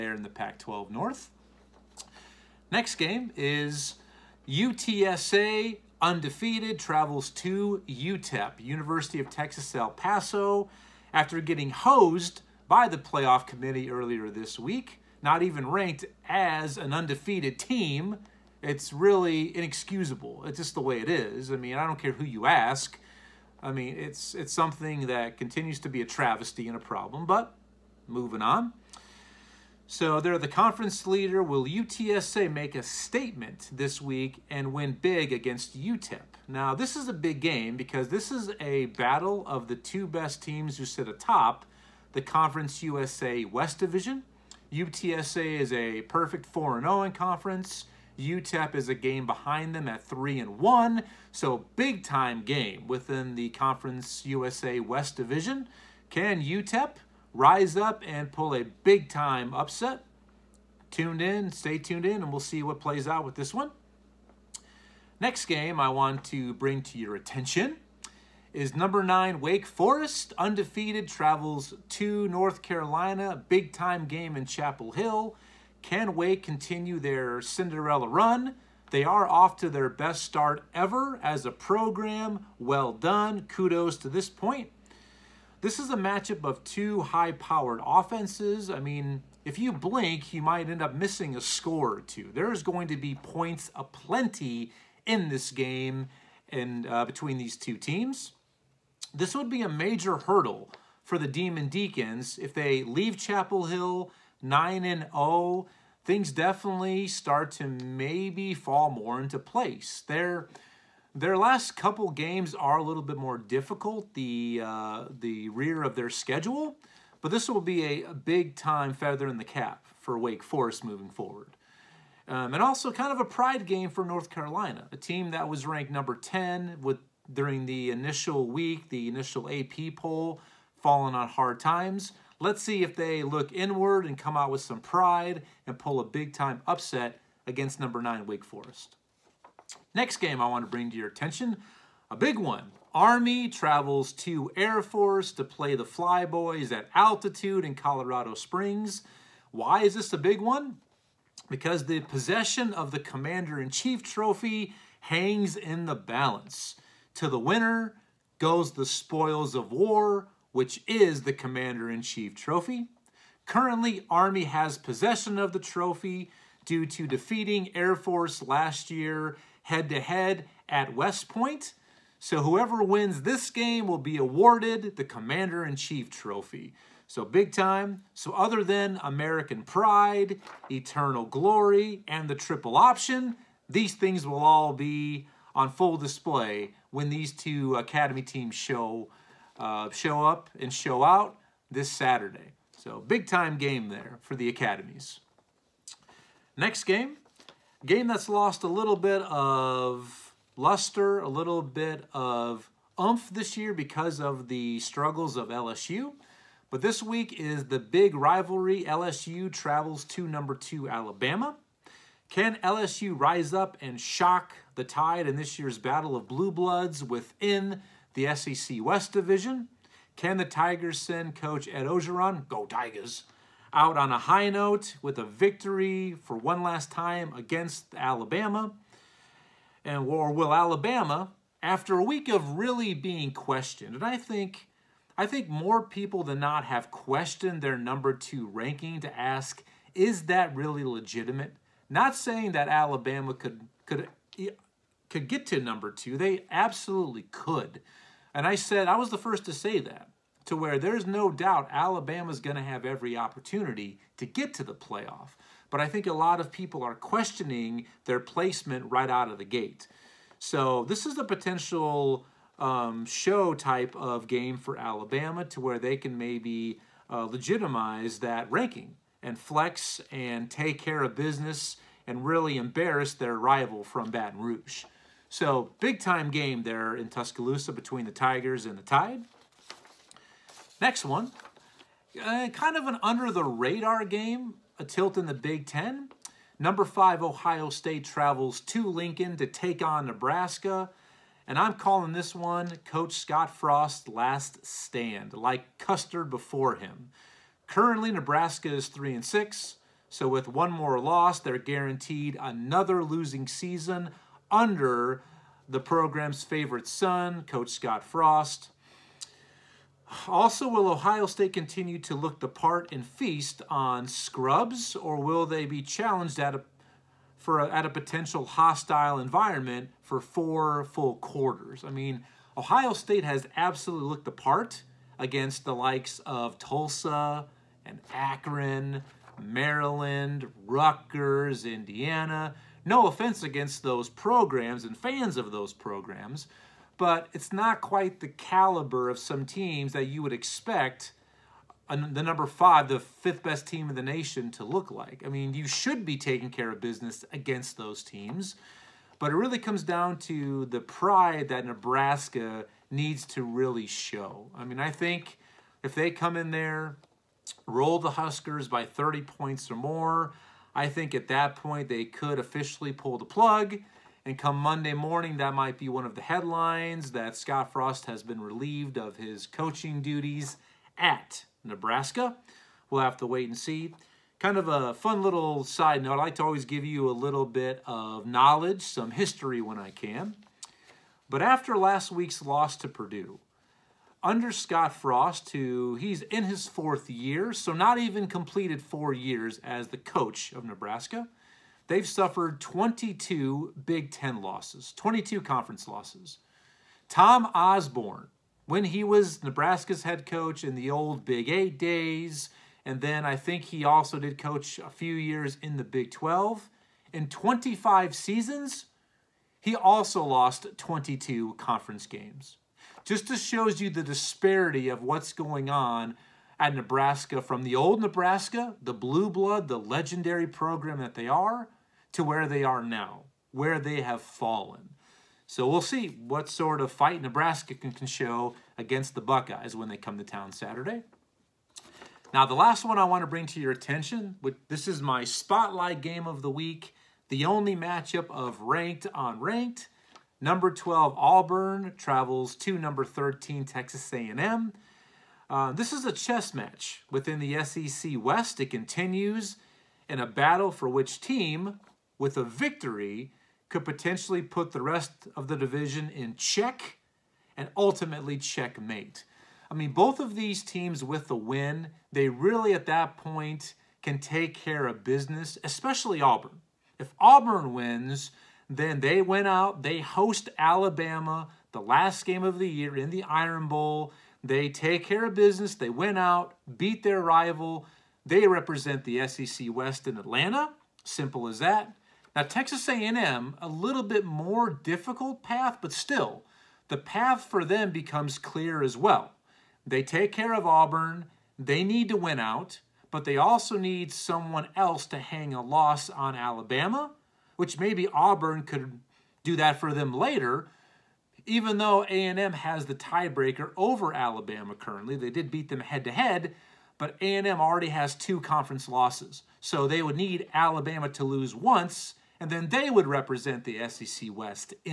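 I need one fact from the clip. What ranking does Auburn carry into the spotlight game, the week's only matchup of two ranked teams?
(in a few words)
12.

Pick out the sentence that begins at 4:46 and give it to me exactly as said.
Number five, Ohio State travels to Lincoln to take on Nebraska.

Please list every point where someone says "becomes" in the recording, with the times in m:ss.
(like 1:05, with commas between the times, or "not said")
8:07.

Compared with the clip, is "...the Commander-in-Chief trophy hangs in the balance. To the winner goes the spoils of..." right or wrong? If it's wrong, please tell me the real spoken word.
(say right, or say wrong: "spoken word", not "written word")
right.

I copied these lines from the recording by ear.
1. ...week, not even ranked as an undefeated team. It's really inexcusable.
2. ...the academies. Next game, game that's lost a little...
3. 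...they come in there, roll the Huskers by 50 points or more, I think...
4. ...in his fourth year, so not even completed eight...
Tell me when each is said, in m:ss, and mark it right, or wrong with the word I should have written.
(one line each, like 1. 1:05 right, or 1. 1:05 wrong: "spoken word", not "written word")
1. 0:14 right
2. 3:14 right
3. 5:55 wrong: "30", not "50"
4. 6:26 wrong: "four", not "eight".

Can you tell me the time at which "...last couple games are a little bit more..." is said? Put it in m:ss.
1:51.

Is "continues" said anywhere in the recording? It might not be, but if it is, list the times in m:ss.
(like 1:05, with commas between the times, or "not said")
0:25, 1:16, 5:11, 7:28.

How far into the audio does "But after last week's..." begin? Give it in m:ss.
6:21.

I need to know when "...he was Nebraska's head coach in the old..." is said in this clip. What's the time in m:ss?
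6:38.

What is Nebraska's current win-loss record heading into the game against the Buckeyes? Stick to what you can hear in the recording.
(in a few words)
3-6.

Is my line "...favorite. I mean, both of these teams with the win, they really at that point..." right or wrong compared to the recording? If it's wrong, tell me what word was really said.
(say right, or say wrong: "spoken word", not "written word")
wrong: "checkmate", not "favorite".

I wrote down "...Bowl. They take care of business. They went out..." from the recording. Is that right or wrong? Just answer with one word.
right.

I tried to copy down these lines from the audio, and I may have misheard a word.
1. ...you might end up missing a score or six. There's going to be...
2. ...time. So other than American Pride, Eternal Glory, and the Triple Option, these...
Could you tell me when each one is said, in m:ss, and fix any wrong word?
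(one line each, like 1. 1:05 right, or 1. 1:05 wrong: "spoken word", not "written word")
1. 1:30 wrong: "two", not "six"
2. 2:57 right.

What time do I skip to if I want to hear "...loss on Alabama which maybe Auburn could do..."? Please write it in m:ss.
8:15.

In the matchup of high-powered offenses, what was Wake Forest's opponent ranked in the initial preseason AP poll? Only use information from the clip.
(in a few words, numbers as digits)
10.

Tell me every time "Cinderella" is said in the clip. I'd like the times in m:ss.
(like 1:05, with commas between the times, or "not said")
1:17.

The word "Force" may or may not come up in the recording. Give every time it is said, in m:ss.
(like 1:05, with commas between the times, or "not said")
2:24, 2:47.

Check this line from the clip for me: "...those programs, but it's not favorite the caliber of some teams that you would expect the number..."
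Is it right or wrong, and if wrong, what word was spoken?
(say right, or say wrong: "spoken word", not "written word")
wrong: "quite", not "favorite".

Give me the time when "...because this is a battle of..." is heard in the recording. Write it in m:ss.
0:37.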